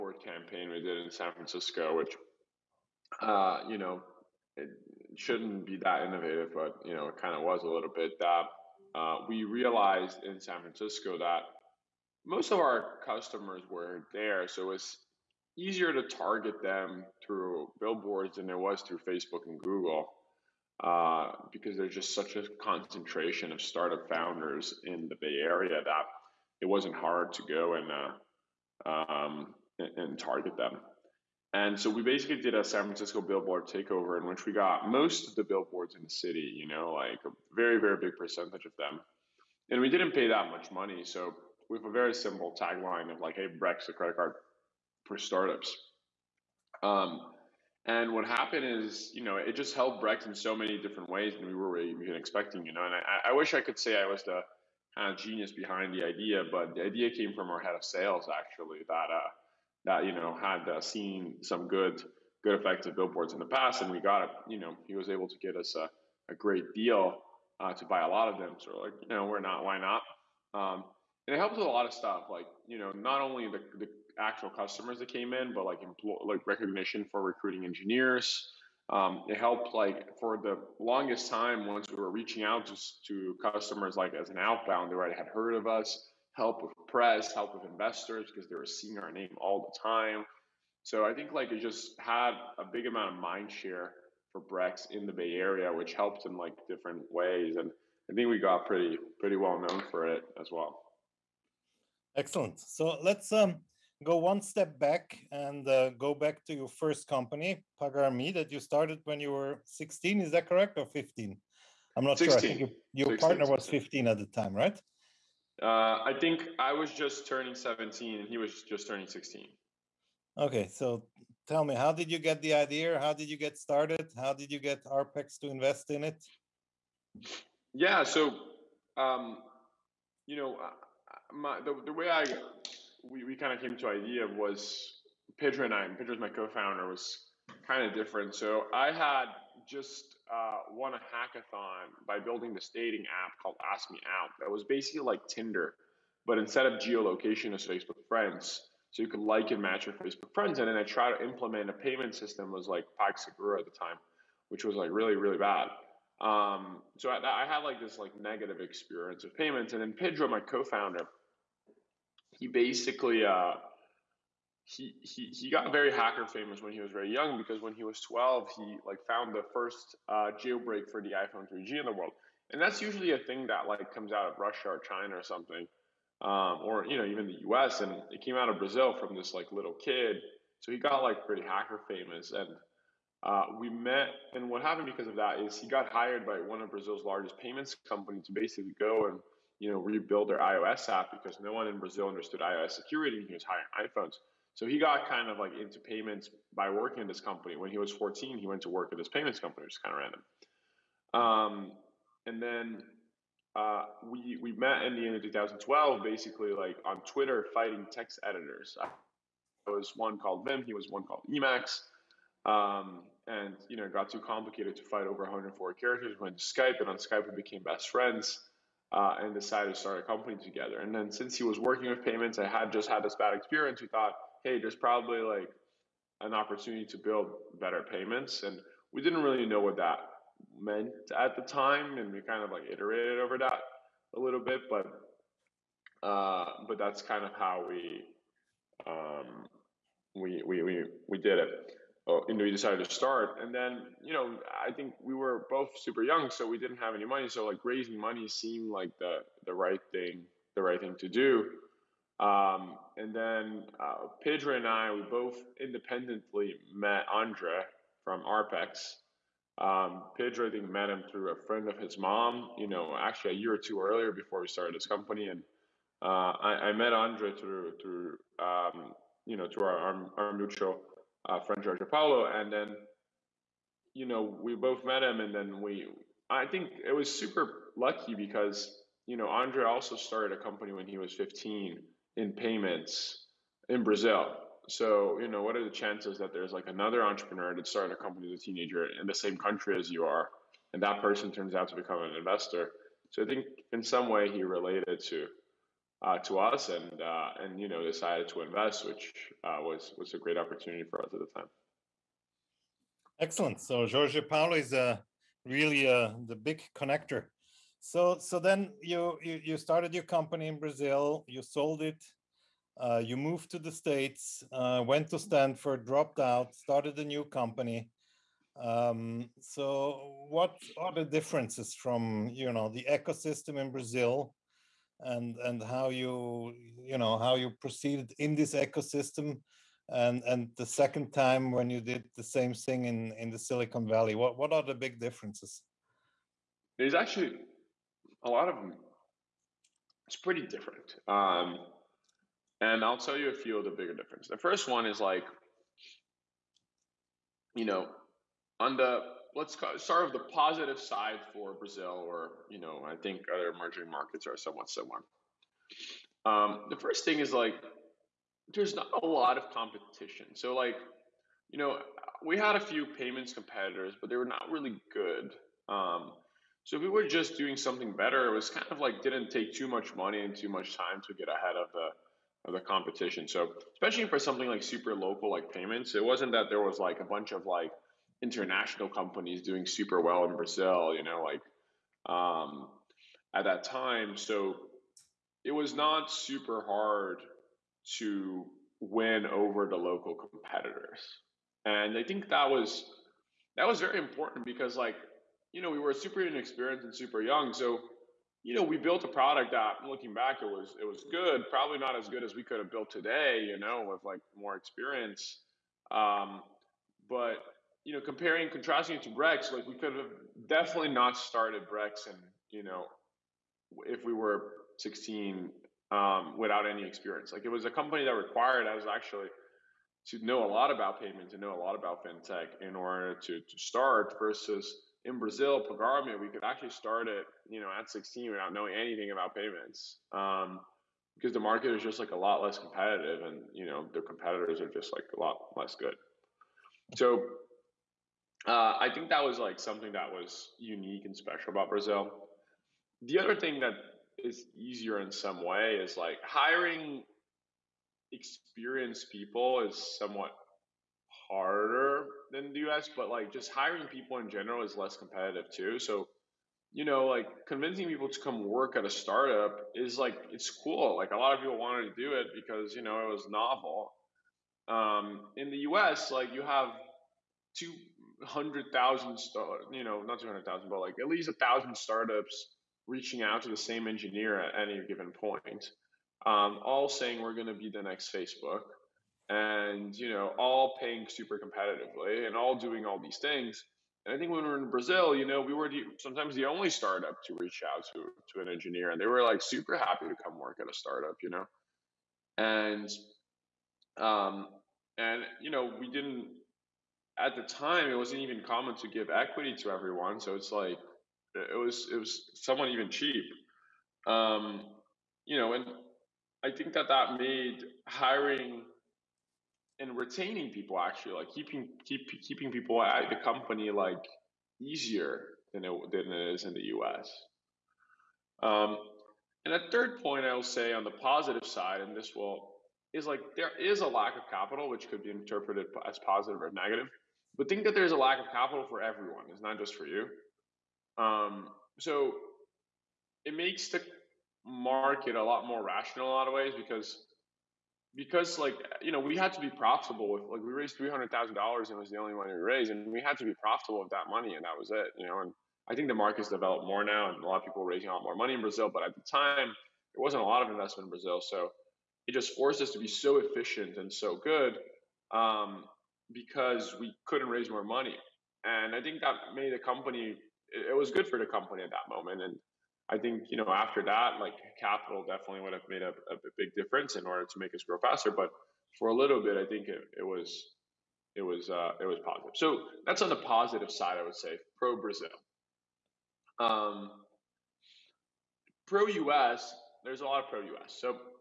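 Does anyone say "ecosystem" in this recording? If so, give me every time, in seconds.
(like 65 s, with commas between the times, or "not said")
322 s, 328 s.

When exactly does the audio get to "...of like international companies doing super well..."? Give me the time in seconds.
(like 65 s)
377 s.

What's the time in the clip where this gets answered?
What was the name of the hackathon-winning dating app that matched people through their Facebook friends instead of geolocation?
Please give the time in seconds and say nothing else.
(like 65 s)
143 s.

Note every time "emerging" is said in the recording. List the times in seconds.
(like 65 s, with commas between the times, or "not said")
353 s.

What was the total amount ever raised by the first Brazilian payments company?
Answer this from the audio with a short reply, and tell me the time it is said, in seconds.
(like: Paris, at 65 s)
$300,000, at 540 s.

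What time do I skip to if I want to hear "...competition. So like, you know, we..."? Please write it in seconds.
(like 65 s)
359 s.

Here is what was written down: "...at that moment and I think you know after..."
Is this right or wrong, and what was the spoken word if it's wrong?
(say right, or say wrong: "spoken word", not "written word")
right.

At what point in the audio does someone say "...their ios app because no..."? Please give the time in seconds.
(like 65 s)
190 s.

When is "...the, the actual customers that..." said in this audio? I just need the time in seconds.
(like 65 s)
73 s.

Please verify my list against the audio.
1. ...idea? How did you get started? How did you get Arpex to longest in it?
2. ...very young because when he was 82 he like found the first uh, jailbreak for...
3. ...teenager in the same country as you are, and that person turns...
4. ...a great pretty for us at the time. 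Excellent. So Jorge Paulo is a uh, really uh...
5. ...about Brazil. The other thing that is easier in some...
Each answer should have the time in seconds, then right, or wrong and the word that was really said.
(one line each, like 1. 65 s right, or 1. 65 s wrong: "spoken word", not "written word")
1. 122 s wrong: "invest", not "longest"
2. 166 s wrong: "12", not "82"
3. 288 s right
4. 300 s wrong: "opportunity", not "pretty"
5. 441 s right.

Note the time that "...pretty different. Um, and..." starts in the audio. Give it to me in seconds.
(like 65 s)
340 s.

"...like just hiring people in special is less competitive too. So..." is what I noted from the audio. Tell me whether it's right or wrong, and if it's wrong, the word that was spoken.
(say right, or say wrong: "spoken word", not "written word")
wrong: "general", not "special".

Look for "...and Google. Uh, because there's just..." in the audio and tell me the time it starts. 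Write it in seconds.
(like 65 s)
19 s.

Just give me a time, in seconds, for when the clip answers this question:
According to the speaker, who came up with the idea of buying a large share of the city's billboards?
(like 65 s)
57 s.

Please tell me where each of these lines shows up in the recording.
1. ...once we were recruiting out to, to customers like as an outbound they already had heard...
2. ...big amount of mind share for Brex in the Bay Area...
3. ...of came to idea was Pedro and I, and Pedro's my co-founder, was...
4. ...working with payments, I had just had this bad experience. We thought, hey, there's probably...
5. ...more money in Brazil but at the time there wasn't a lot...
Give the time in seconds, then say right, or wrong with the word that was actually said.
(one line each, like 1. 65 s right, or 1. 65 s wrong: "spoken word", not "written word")
1. 81 s wrong: "reaching", not "recruiting"
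2. 92 s right
3. 133 s right
4. 221 s right
5. 548 s right.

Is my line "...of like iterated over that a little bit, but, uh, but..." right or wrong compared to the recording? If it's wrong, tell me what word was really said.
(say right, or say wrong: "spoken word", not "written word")
right.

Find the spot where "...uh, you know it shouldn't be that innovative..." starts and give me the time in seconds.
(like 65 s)
3 s.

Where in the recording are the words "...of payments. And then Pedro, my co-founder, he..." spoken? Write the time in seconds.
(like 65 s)
159 s.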